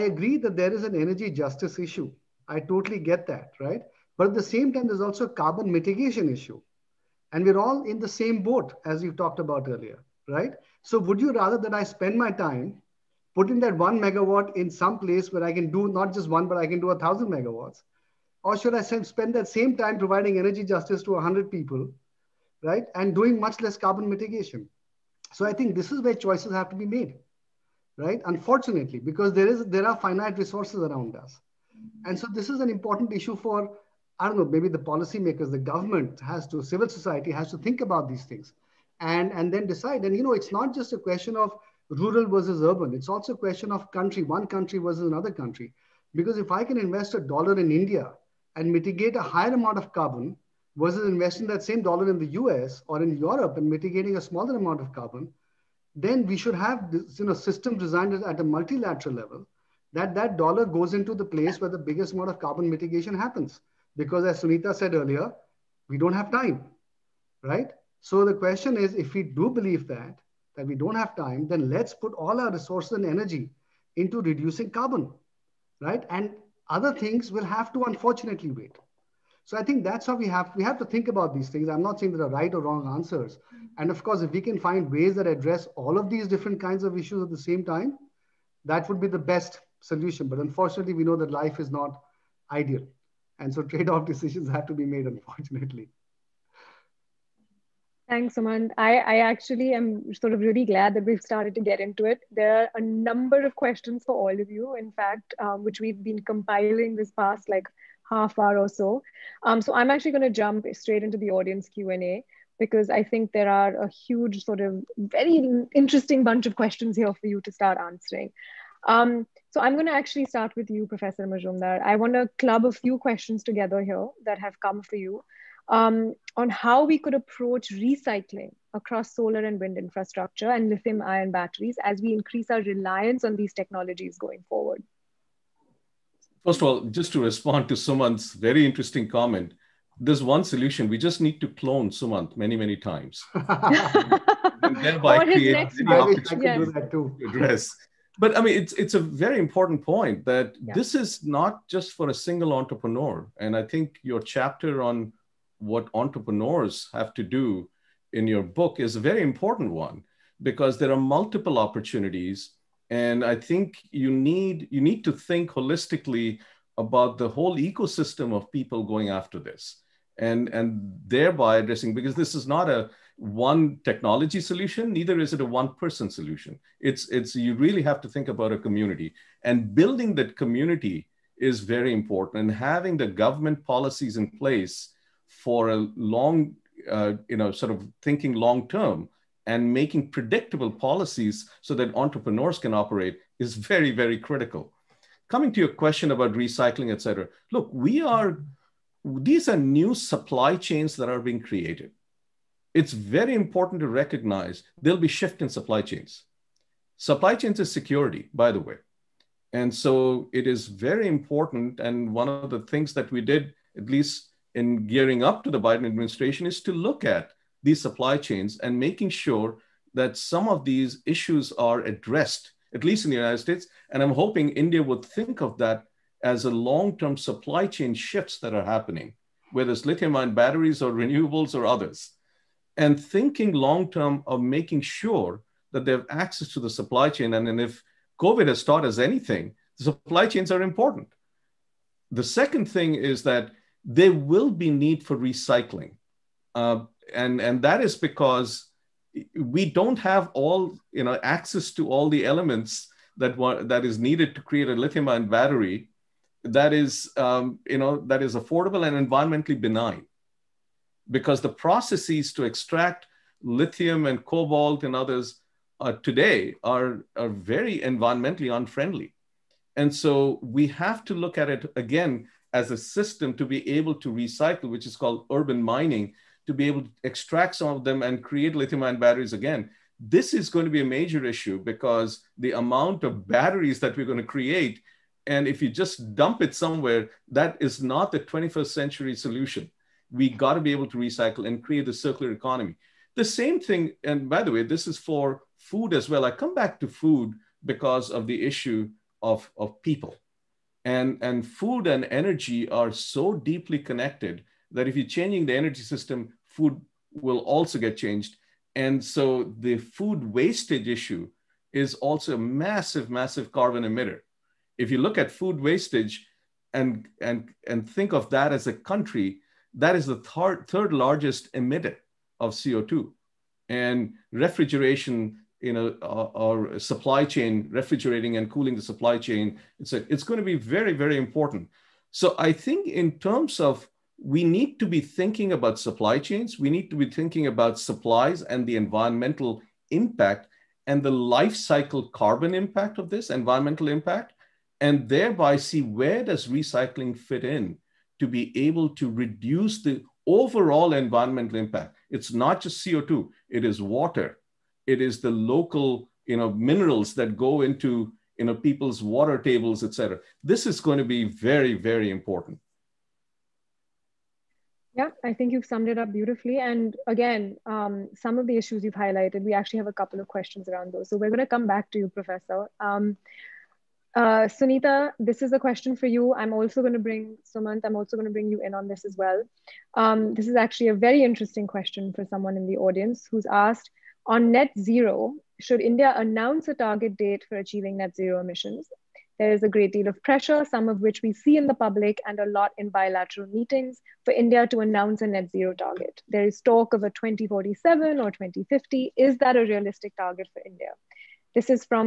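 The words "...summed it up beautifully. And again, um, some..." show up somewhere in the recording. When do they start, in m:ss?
6:05.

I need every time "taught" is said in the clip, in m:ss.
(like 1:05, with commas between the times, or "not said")
3:58.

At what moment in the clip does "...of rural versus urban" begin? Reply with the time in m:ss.
0:41.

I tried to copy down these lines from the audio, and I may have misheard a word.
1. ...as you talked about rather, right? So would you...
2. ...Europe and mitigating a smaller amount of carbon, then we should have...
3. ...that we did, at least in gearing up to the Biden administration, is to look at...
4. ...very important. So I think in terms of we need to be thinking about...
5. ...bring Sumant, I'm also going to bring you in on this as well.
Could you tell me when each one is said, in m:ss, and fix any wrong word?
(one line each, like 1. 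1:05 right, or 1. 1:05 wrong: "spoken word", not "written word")
1. 0:08 wrong: "earlier", not "rather"
2. 0:53 right
3. 3:32 right
4. 5:30 right
5. 6:17 right.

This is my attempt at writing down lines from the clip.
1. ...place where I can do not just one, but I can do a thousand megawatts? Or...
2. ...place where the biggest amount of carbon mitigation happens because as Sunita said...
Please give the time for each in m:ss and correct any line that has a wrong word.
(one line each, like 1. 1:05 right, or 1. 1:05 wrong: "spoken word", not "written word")
1. 0:15 right
2. 1:01 right.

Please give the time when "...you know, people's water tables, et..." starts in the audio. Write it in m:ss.
5:58.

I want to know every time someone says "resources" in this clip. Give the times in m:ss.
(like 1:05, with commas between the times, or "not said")
0:30, 1:12.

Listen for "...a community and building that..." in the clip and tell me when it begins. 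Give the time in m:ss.
2:58.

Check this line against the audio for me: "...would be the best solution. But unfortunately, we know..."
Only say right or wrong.
right.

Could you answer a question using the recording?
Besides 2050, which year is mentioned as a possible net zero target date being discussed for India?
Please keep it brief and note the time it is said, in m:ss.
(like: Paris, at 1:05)
2047, at 6:37.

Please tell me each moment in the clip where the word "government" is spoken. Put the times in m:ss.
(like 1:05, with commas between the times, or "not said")
0:35, 3:03.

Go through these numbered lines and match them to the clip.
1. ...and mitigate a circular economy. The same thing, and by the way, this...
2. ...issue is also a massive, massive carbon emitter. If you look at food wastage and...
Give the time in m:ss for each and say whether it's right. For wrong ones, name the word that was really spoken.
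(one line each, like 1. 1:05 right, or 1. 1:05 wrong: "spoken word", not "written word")
1. 4:51 wrong: "create", not "mitigate"
2. 5:10 right.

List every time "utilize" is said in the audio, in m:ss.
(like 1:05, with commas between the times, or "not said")
not said.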